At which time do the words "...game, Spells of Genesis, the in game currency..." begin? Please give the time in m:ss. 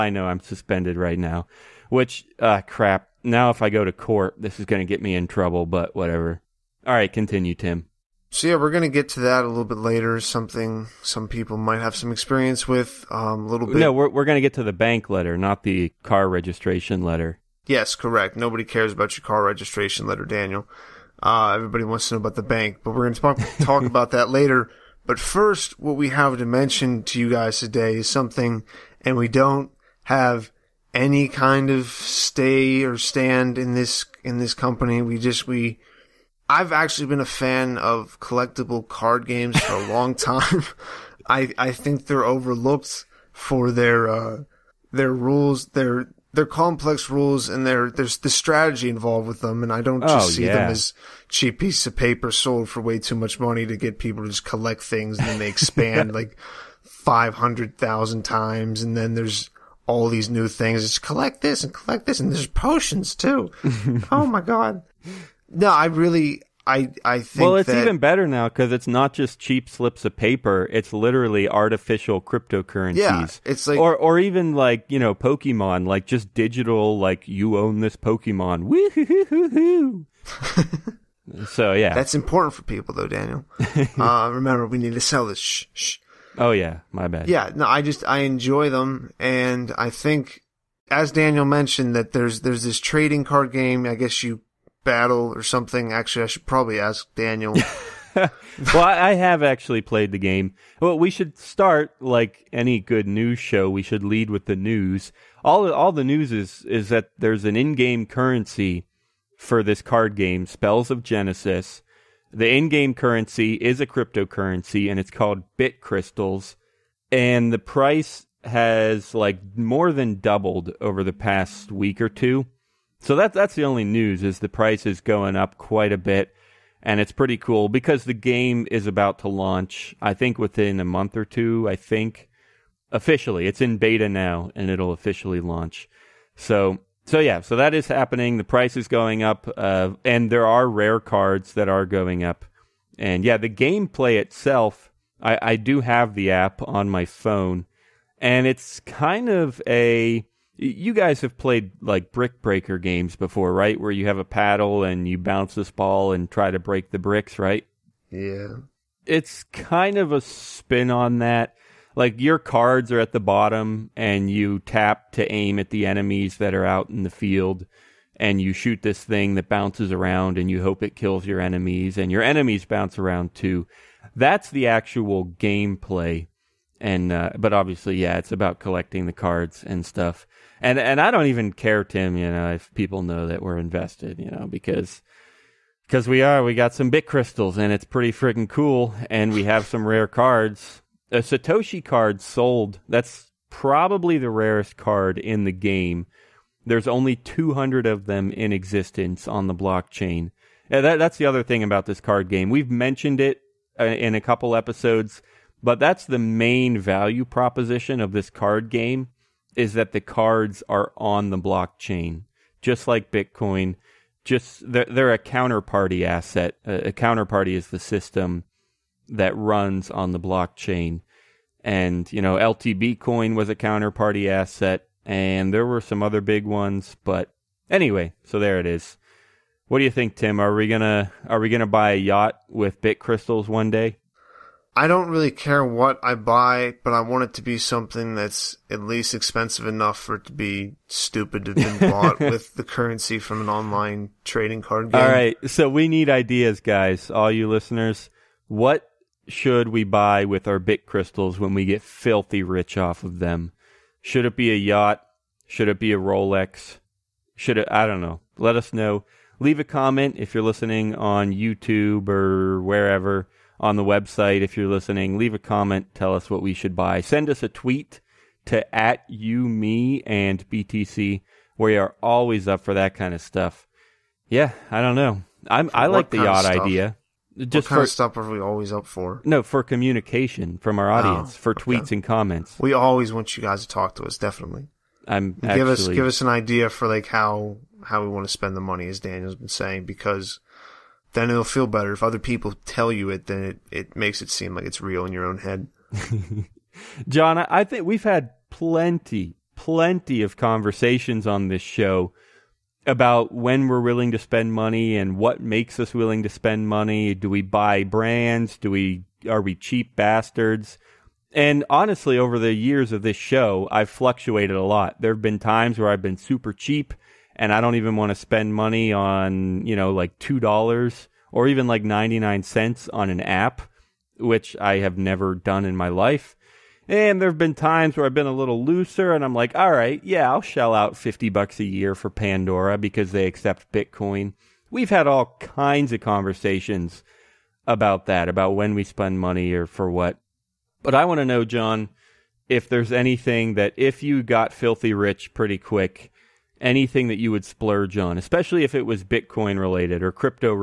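1:50.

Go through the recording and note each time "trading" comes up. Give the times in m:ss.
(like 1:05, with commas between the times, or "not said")
1:32, 4:04.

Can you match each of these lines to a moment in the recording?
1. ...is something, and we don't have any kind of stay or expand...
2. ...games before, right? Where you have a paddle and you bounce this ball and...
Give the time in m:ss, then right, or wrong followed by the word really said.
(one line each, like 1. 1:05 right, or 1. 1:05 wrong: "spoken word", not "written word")
1. 0:27 wrong: "stand", not "expand"
2. 2:32 right.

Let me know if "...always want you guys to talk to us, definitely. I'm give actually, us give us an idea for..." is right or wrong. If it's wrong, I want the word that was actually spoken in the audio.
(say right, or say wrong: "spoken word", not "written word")
right.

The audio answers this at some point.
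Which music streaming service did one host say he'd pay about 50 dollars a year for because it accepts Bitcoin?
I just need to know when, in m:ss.
5:32.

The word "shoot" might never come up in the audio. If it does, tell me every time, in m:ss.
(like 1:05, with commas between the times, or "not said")
2:48.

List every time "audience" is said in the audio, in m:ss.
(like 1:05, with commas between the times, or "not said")
4:40.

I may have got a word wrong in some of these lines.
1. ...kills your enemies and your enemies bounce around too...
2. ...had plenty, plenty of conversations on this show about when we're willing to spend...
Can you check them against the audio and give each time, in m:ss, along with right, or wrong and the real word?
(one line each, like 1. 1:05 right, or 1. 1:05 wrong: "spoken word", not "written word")
1. 2:50 right
2. 4:58 right.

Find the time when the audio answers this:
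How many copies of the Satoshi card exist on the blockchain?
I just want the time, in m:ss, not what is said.
3:17.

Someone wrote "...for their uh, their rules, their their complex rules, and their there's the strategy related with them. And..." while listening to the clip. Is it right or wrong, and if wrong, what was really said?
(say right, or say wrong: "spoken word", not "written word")
wrong: "involved", not "related".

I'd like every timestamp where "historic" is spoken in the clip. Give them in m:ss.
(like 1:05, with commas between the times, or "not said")
not said.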